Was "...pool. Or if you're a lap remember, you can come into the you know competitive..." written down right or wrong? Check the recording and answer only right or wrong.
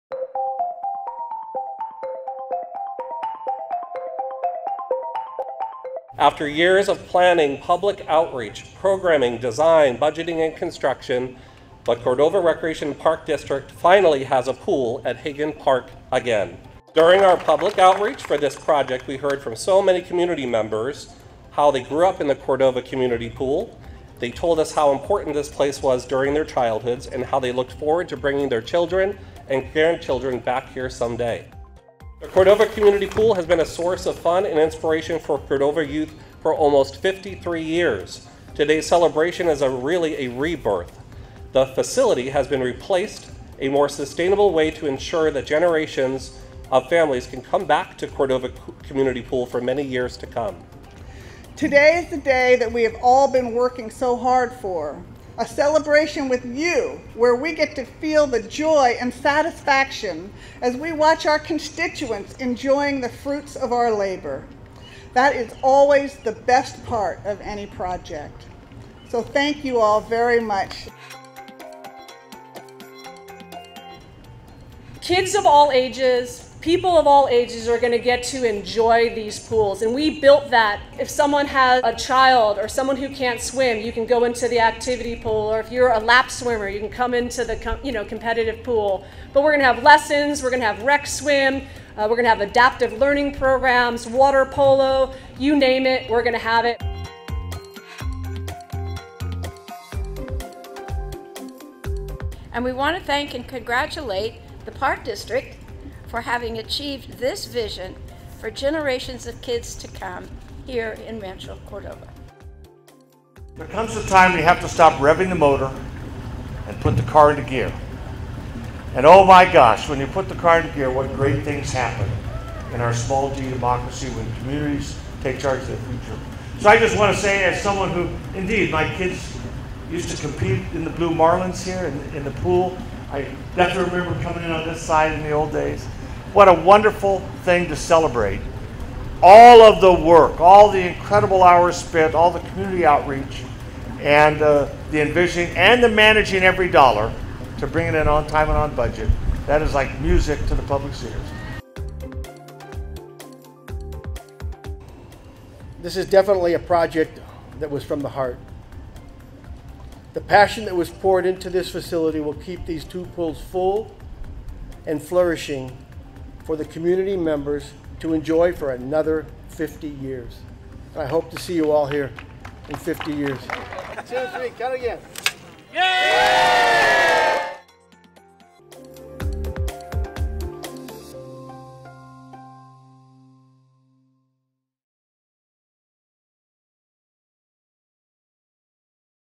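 wrong.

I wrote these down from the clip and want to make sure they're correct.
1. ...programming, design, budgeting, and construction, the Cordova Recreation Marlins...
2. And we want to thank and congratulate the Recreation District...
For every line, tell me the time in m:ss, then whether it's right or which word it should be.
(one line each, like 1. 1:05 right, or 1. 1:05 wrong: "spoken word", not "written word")
1. 0:08 wrong: "Park", not "Marlins"
2. 1:42 wrong: "Park", not "Recreation".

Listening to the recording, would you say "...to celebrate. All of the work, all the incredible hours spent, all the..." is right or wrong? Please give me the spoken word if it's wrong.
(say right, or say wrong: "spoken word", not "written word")
right.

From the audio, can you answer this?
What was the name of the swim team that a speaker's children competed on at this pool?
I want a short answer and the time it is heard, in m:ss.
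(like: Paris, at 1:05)
Blue Marlins, at 2:10.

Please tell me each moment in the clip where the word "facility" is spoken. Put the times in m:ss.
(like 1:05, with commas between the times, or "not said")
0:41, 2:41.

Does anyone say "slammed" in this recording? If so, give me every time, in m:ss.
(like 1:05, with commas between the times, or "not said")
not said.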